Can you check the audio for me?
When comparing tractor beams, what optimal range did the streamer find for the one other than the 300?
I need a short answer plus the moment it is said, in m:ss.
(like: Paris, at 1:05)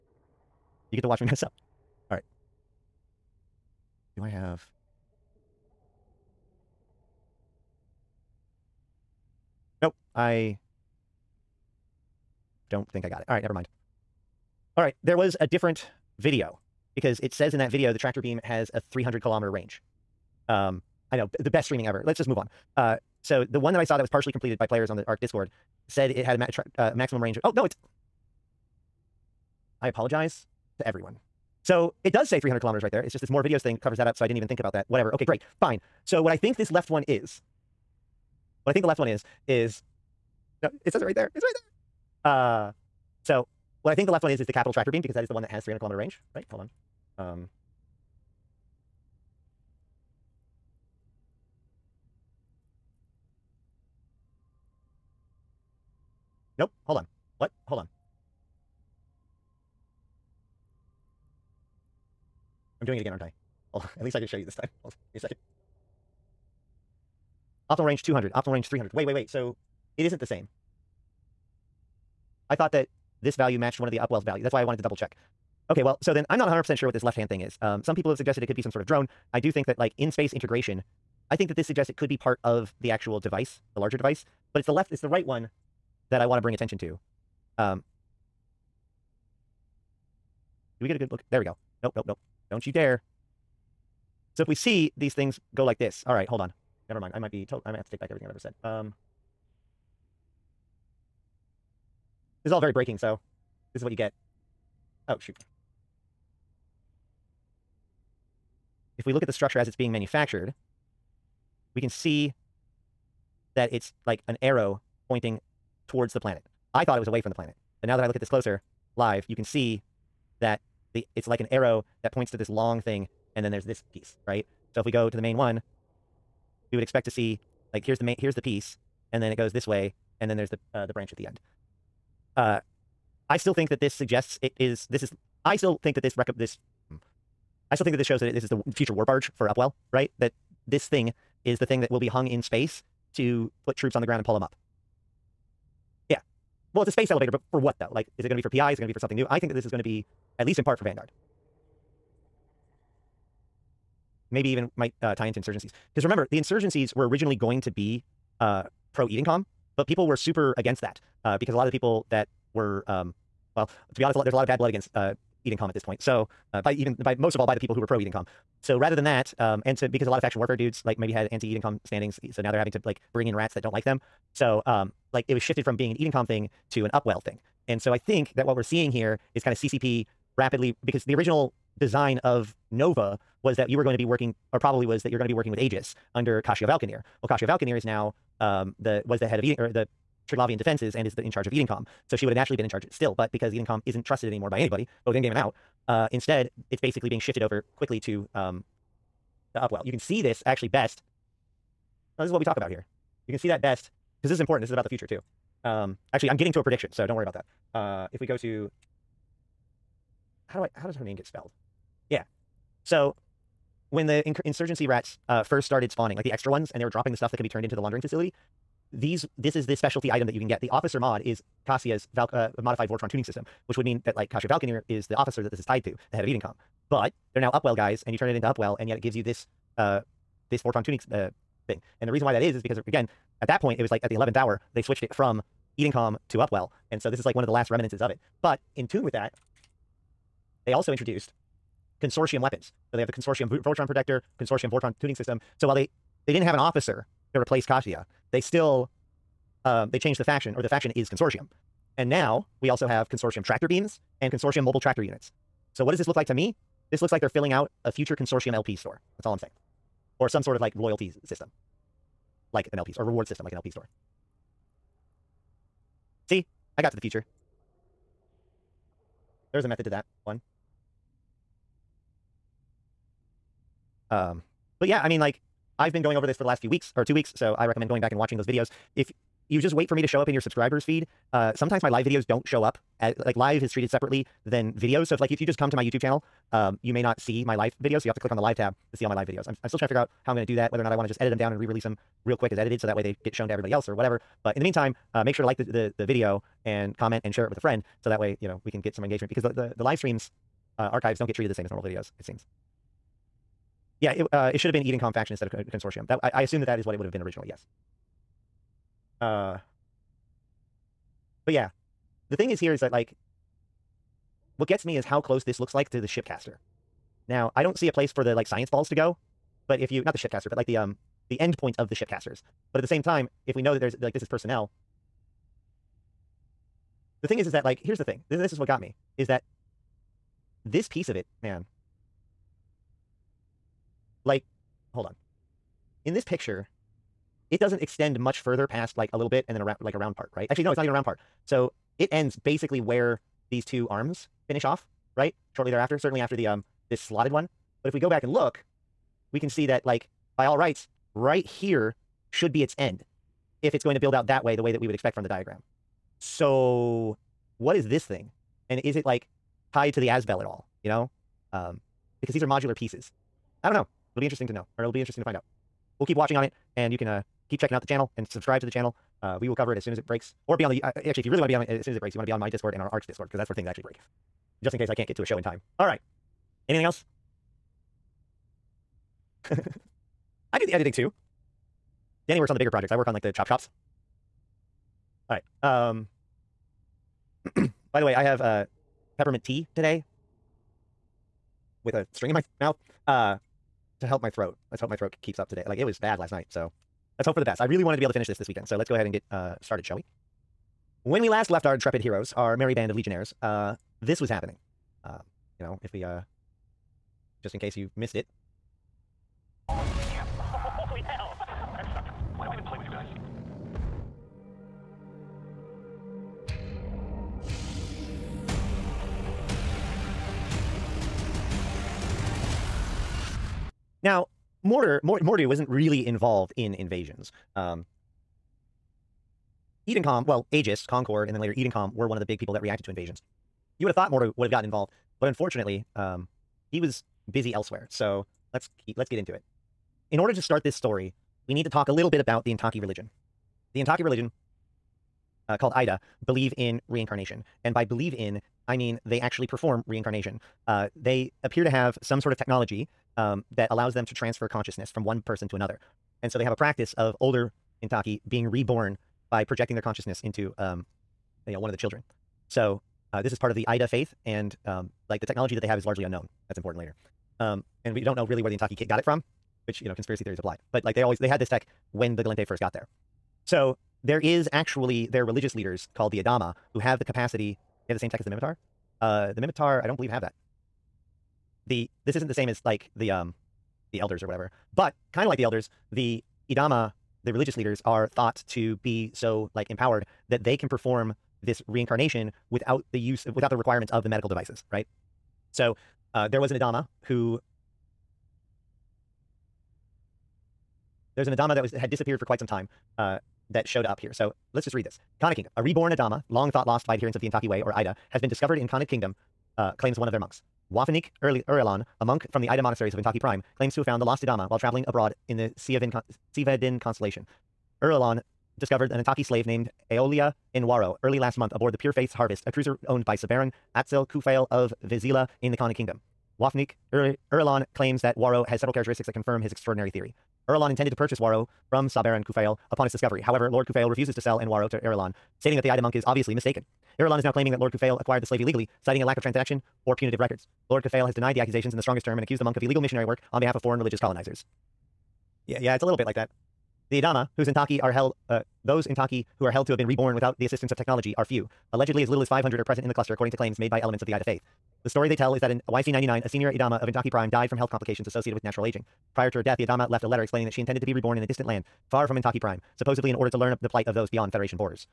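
200, at 1:07.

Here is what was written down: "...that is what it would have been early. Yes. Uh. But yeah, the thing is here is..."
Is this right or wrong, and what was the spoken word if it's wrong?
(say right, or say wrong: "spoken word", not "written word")
wrong: "originally", not "early".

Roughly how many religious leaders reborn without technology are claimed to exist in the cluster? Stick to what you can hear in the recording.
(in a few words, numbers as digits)
500.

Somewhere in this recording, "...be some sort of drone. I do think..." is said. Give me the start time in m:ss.
1:18.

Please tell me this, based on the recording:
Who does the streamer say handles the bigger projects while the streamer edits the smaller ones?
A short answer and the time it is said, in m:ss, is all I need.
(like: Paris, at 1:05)
Danny, at 6:22.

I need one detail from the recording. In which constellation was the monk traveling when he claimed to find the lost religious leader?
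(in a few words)
Sivadin.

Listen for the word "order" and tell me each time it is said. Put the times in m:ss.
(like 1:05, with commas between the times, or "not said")
7:20, 9:23.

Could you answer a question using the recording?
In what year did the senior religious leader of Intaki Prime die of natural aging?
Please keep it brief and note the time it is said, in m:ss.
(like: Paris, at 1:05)
YC 99, at 9:15.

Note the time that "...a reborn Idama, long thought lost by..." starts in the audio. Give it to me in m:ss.
8:25.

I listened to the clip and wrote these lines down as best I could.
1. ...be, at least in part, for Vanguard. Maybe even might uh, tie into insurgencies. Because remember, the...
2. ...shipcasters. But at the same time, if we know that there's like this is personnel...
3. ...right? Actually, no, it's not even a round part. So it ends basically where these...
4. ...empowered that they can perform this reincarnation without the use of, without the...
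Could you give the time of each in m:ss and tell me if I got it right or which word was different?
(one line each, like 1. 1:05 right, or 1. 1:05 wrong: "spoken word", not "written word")
1. 2:29 right
2. 5:21 right
3. 5:40 right
4. 8:09 right.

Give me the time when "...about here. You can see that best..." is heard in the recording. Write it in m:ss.
3:22.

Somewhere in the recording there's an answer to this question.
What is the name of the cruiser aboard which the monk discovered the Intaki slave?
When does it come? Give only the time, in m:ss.
8:41.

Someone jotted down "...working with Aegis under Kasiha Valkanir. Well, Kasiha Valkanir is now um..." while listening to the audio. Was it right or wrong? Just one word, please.
right.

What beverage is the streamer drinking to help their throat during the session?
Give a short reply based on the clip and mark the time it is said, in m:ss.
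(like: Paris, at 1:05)
peppermint tea, at 6:29.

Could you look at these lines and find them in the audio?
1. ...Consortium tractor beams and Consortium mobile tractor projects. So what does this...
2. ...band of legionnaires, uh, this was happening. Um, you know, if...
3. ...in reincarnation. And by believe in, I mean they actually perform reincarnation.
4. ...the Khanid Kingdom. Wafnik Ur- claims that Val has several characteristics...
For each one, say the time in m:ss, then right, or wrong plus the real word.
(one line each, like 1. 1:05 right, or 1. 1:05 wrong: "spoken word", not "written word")
1. 4:13 wrong: "units", not "projects"
2. 6:42 right
3. 7:26 right
4. 8:45 wrong: "Waro", not "Val".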